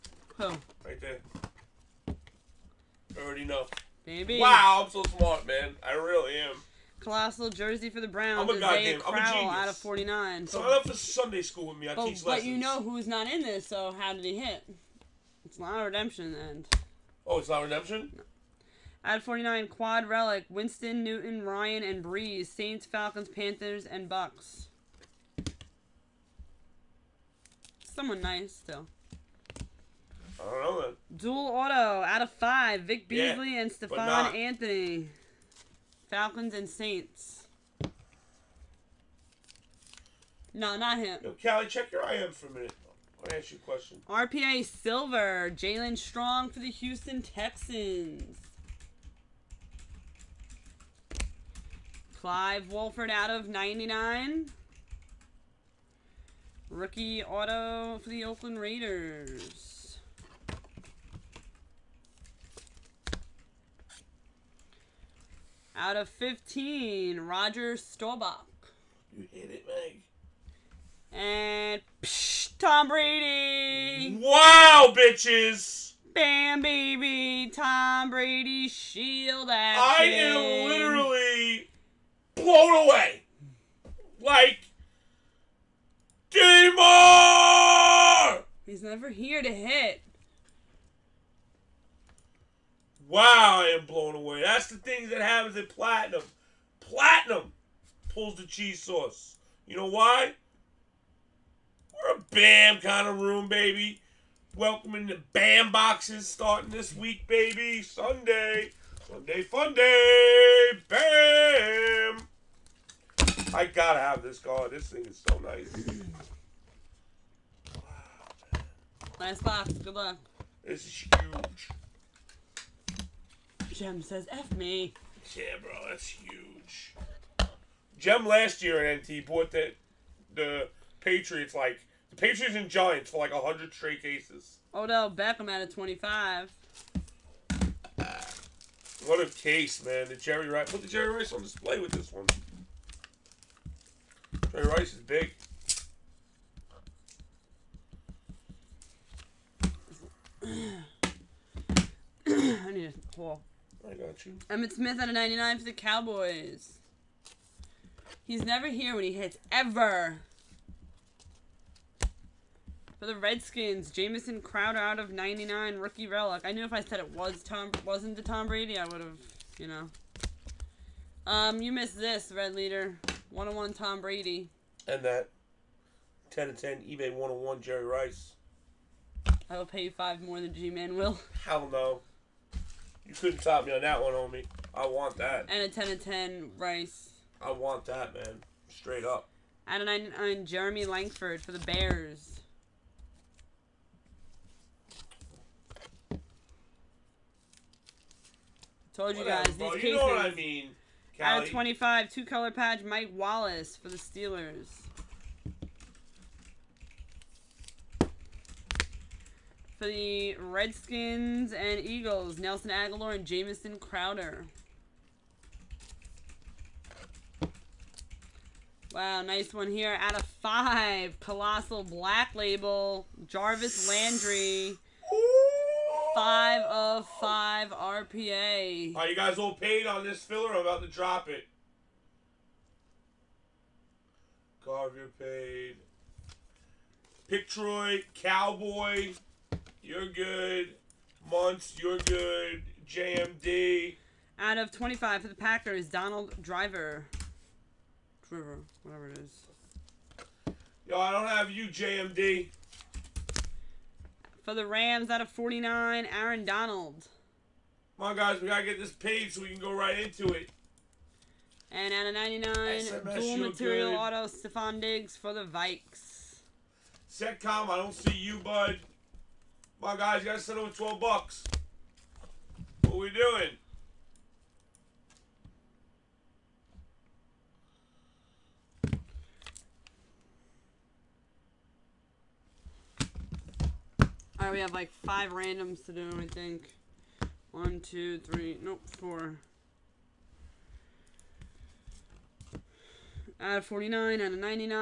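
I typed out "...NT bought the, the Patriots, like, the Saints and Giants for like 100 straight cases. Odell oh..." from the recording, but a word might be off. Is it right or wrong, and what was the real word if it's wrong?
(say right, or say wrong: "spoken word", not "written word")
wrong: "Patriots", not "Saints".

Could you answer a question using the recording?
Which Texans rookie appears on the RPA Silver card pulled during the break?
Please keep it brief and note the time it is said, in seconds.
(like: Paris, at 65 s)
Jaelen Strong, at 45 s.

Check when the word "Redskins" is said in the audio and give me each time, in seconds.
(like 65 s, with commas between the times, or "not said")
163 s, 210 s.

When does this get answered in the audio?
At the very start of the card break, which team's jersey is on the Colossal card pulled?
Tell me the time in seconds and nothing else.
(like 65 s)
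8 s.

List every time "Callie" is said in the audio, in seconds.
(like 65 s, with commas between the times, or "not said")
41 s, 201 s.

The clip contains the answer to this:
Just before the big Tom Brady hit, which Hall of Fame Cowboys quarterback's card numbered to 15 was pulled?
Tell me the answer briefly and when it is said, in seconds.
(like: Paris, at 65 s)
Roger Staubach, at 67 s.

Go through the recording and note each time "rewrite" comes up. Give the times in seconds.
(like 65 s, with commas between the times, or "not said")
not said.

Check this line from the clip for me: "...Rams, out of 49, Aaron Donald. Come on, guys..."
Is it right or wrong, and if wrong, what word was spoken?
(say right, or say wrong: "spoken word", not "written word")
right.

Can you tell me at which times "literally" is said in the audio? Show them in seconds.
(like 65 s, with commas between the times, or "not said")
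80 s.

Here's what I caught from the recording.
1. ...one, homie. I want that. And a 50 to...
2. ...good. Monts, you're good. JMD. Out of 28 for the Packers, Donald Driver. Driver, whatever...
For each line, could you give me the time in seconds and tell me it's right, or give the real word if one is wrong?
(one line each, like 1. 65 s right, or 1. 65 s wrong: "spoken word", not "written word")
1. 184 s wrong: "10", not "50"
2. 240 s wrong: "25", not "28".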